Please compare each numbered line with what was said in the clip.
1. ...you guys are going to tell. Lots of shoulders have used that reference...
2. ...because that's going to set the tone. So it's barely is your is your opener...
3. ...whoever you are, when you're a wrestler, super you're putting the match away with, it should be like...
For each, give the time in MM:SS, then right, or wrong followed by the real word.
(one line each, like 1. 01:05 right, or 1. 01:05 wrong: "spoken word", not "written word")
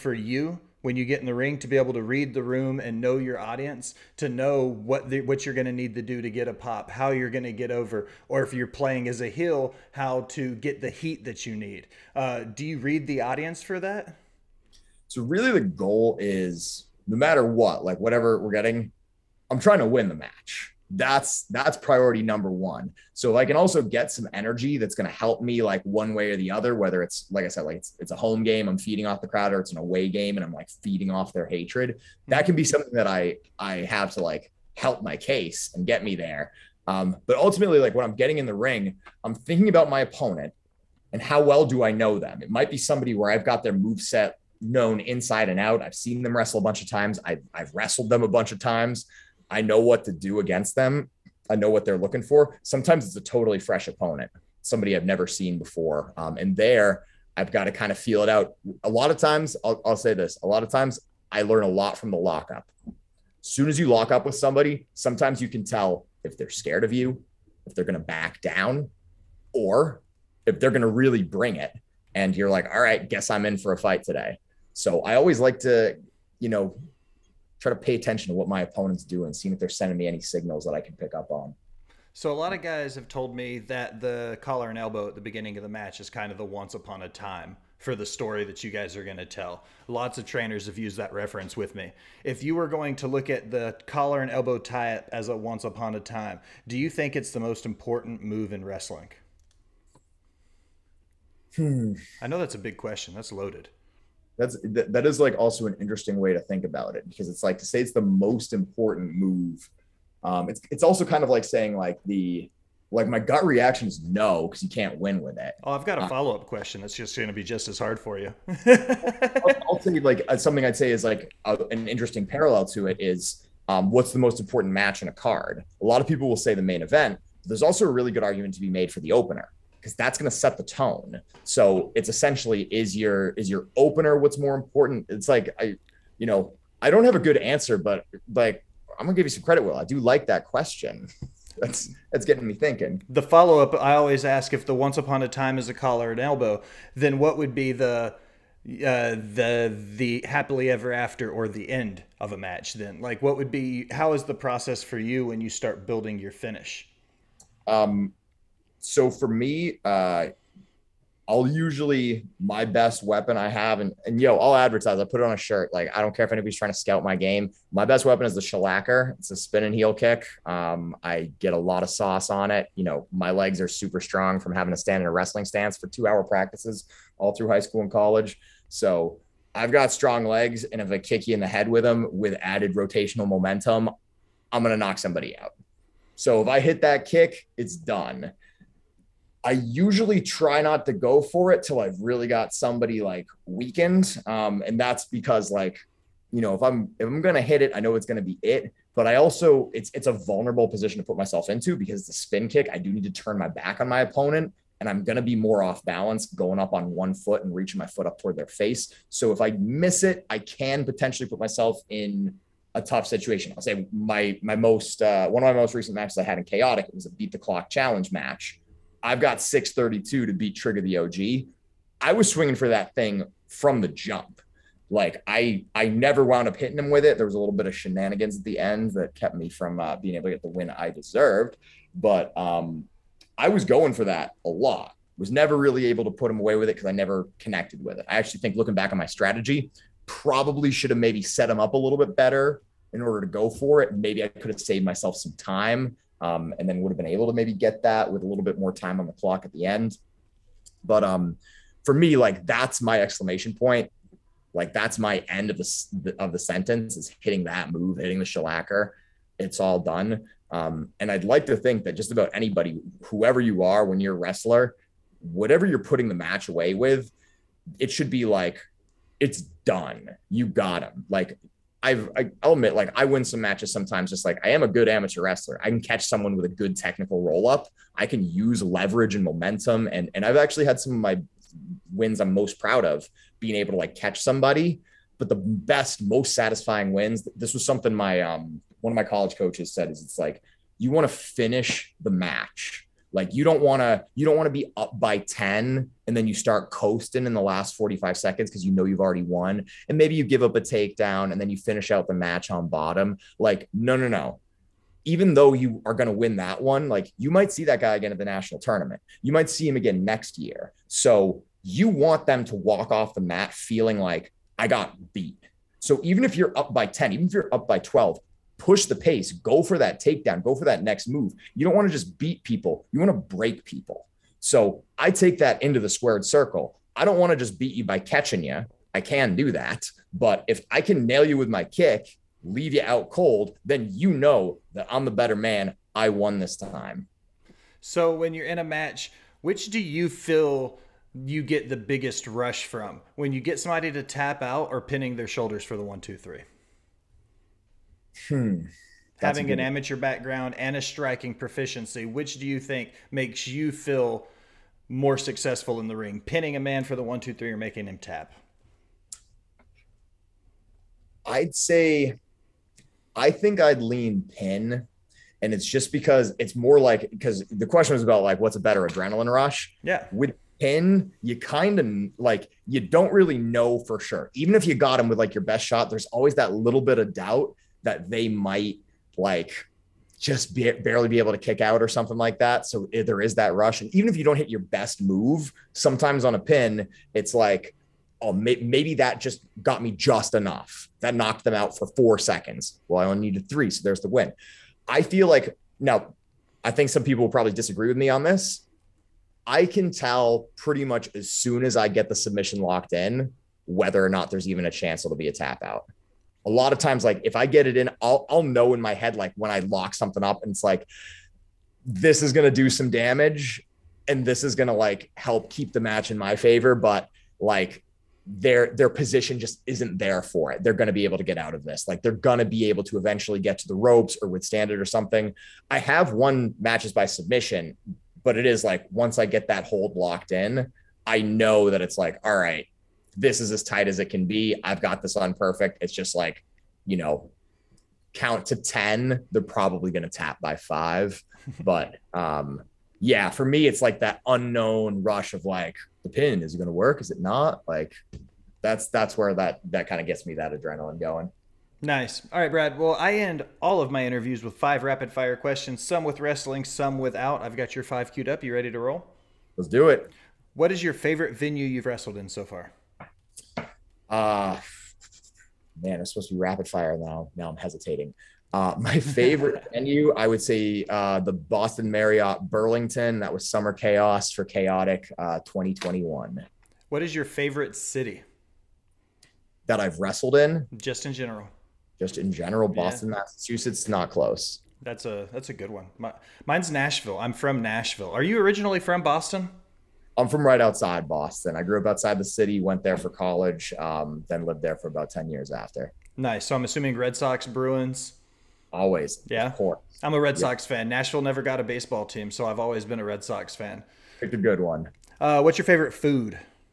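1. 01:28 wrong: "trainers", not "shoulders"
2. 02:09 wrong: "essentially", not "barely"
3. 04:23 wrong: "whatever", not "super".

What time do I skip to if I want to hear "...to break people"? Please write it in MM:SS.
05:23.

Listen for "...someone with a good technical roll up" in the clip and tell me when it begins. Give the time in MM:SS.
04:36.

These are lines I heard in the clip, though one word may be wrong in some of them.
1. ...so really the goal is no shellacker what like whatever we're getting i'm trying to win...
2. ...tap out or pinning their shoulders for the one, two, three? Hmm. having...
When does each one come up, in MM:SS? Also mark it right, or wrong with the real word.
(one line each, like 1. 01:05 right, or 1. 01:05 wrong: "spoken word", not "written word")
1. 00:15 wrong: "matter", not "shellacker"
2. 05:44 right.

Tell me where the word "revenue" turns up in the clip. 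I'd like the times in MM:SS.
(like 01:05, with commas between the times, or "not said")
not said.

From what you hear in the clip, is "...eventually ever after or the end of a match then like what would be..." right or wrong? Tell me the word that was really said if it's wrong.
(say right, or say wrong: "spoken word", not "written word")
wrong: "happily", not "eventually".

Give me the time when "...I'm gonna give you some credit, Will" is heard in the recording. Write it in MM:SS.
02:18.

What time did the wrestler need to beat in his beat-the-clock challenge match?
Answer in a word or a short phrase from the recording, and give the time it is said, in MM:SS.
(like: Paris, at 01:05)
6:32, at 03:39.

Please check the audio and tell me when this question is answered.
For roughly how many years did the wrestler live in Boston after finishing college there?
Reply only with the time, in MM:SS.
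08:15.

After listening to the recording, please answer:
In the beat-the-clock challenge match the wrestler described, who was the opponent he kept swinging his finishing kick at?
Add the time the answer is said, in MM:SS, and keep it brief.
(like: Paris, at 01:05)
Trigger the OG, at 03:40.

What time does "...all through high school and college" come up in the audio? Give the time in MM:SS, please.
02:57.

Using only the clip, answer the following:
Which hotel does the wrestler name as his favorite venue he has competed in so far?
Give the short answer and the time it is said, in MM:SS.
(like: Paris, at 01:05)
Boston Marriott Burlington, at 07:51.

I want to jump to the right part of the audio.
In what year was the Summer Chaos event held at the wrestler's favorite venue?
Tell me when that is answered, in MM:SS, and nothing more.
07:55.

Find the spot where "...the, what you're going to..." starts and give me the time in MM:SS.
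00:05.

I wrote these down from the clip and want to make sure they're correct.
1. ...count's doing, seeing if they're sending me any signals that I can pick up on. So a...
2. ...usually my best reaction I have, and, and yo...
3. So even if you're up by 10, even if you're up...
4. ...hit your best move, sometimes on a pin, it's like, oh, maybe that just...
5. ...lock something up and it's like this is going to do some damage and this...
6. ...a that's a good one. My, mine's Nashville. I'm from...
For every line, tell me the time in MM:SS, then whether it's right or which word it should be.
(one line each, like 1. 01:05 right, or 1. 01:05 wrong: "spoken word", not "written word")
1. 01:18 wrong: "opponent", not "count"
2. 02:41 wrong: "weapon", not "reaction"
3. 05:15 right
4. 06:24 right
5. 06:49 right
6. 08:05 right.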